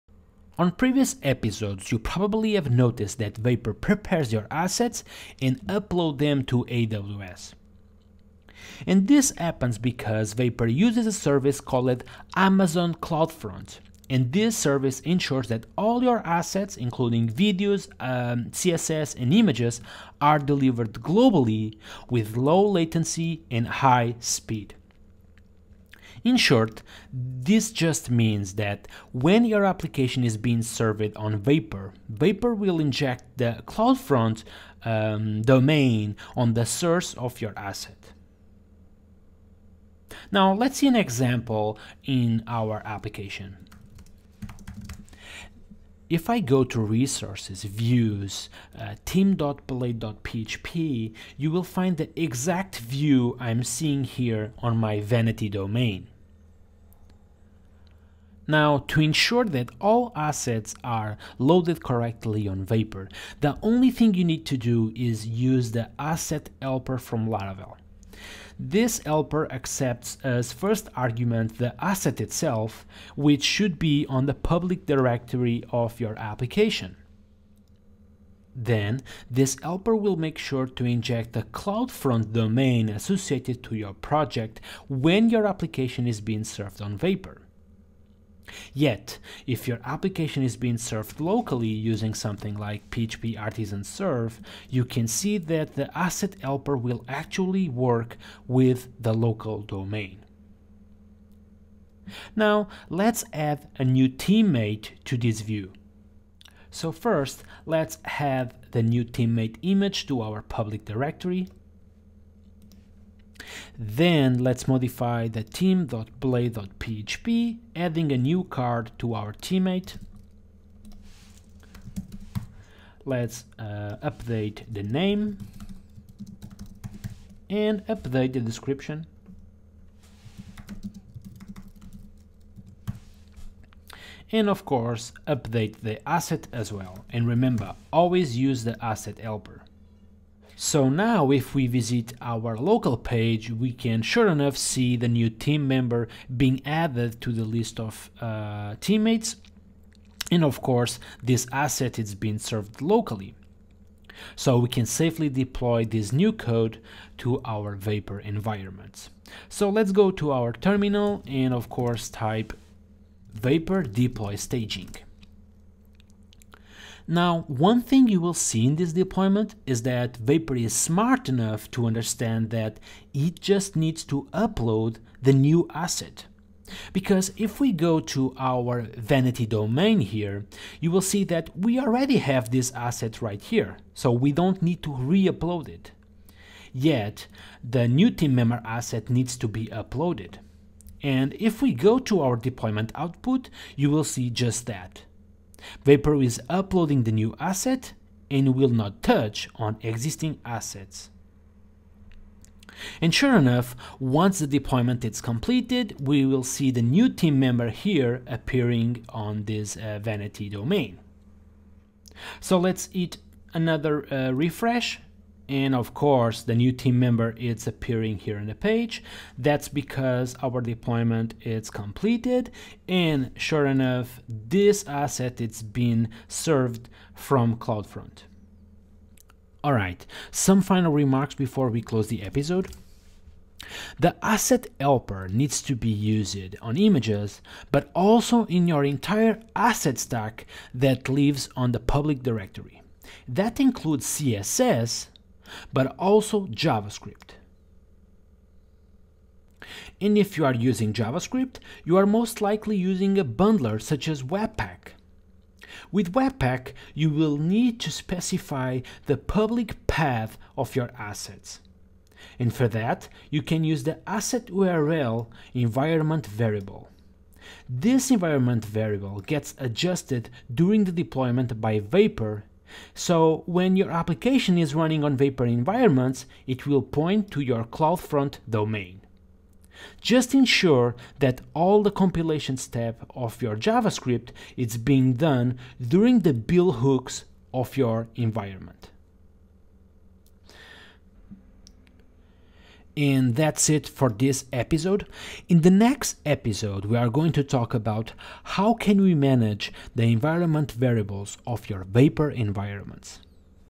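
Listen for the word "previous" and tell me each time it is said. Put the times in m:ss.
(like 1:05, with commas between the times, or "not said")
0:00.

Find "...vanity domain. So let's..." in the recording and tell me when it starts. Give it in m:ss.
3:30.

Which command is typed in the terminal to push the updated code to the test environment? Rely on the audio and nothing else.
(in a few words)
vapor deploy staging.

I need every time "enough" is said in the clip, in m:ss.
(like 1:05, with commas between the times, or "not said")
2:24, 2:51, 3:23, 3:43.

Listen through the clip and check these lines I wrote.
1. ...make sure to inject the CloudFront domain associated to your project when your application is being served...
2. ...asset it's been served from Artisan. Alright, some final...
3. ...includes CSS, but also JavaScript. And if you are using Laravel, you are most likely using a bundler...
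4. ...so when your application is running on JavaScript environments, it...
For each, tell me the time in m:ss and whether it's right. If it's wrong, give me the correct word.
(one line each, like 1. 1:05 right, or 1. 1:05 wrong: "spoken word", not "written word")
1. 1:20 right
2. 3:44 wrong: "CloudFront", not "Artisan"
3. 4:03 wrong: "JavaScript", not "Laravel"
4. 4:32 wrong: "Vapor", not "JavaScript".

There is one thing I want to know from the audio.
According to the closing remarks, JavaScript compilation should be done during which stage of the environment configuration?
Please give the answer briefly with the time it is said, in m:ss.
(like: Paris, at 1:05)
build hooks, at 4:46.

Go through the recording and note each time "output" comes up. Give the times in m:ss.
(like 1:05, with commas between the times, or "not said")
3:12.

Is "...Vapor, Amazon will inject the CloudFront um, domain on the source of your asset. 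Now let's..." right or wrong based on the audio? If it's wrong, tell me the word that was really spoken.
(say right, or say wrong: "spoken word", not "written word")
wrong: "Vapor", not "Amazon".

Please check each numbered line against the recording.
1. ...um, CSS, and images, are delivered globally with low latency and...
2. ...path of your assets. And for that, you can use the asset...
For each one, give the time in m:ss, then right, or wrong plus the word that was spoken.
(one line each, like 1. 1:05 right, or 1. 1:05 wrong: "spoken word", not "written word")
1. 0:18 right
2. 4:19 right.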